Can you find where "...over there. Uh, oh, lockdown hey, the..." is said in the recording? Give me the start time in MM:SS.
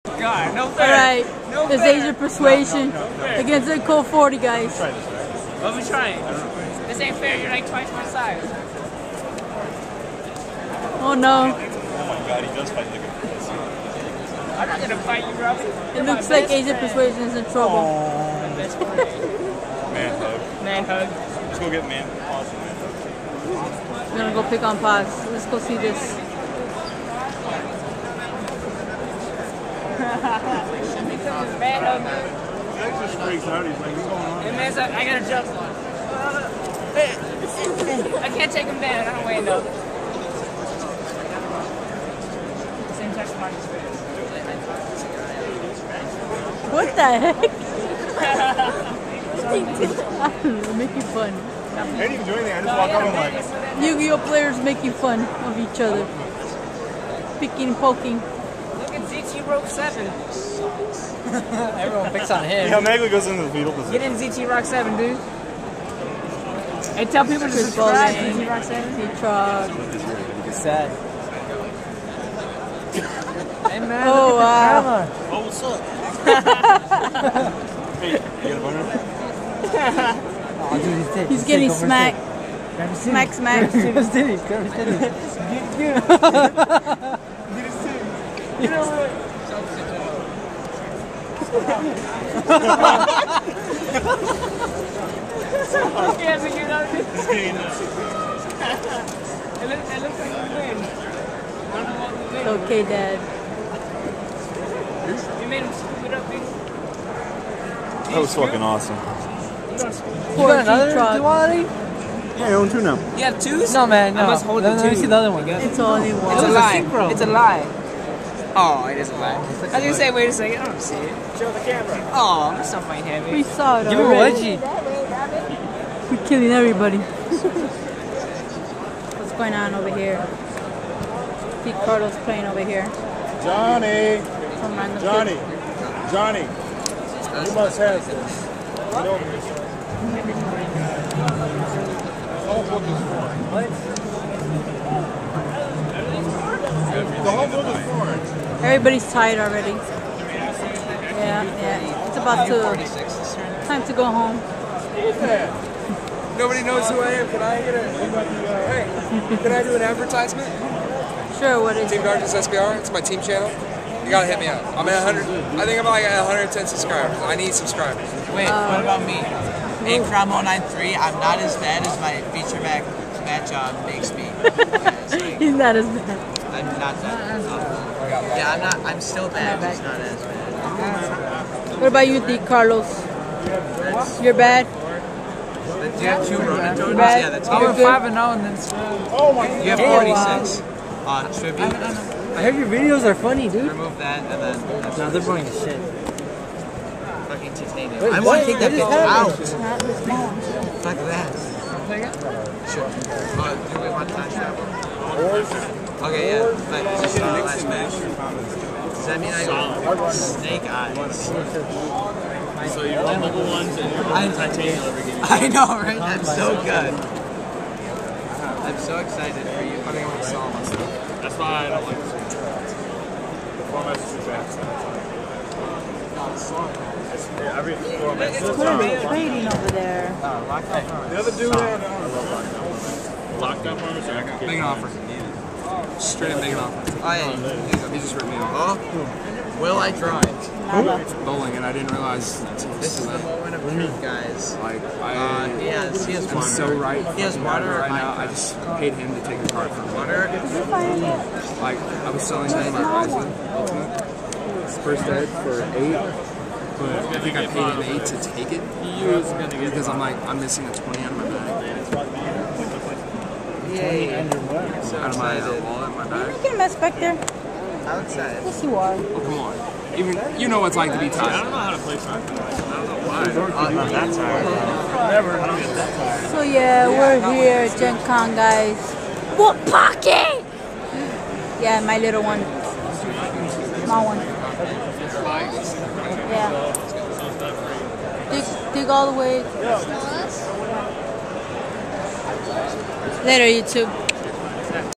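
03:49.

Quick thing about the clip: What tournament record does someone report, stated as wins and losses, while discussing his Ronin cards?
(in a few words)
5 and 0.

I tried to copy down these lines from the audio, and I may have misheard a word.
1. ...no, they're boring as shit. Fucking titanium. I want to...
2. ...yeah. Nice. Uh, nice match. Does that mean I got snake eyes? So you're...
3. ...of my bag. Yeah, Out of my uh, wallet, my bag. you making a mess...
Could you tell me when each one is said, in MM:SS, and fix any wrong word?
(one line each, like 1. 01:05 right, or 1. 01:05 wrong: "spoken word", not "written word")
1. 03:14 right
2. 03:26 right
3. 04:21 right.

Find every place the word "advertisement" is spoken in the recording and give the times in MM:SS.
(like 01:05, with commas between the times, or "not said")
02:39.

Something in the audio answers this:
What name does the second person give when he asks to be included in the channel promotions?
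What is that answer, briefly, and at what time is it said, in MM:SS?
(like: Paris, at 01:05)
Nate Crom 093, at 02:49.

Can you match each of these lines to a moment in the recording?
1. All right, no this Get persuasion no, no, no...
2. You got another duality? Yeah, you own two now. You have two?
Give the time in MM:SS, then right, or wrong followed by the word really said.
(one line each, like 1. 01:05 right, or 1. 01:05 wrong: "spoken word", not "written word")
1. 00:00 wrong: "Asia", not "Get"
2. 01:50 right.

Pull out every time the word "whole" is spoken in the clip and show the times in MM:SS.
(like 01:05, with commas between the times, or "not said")
02:22, 02:27.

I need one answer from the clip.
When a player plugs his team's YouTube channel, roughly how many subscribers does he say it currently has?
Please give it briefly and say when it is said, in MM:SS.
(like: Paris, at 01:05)
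110, at 02:46.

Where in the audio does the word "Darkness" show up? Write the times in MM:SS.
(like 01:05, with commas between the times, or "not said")
02:42.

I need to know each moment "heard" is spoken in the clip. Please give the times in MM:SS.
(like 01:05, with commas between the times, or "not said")
03:12.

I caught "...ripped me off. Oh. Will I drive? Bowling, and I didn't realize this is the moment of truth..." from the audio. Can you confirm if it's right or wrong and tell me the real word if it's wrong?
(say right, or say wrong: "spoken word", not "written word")
right.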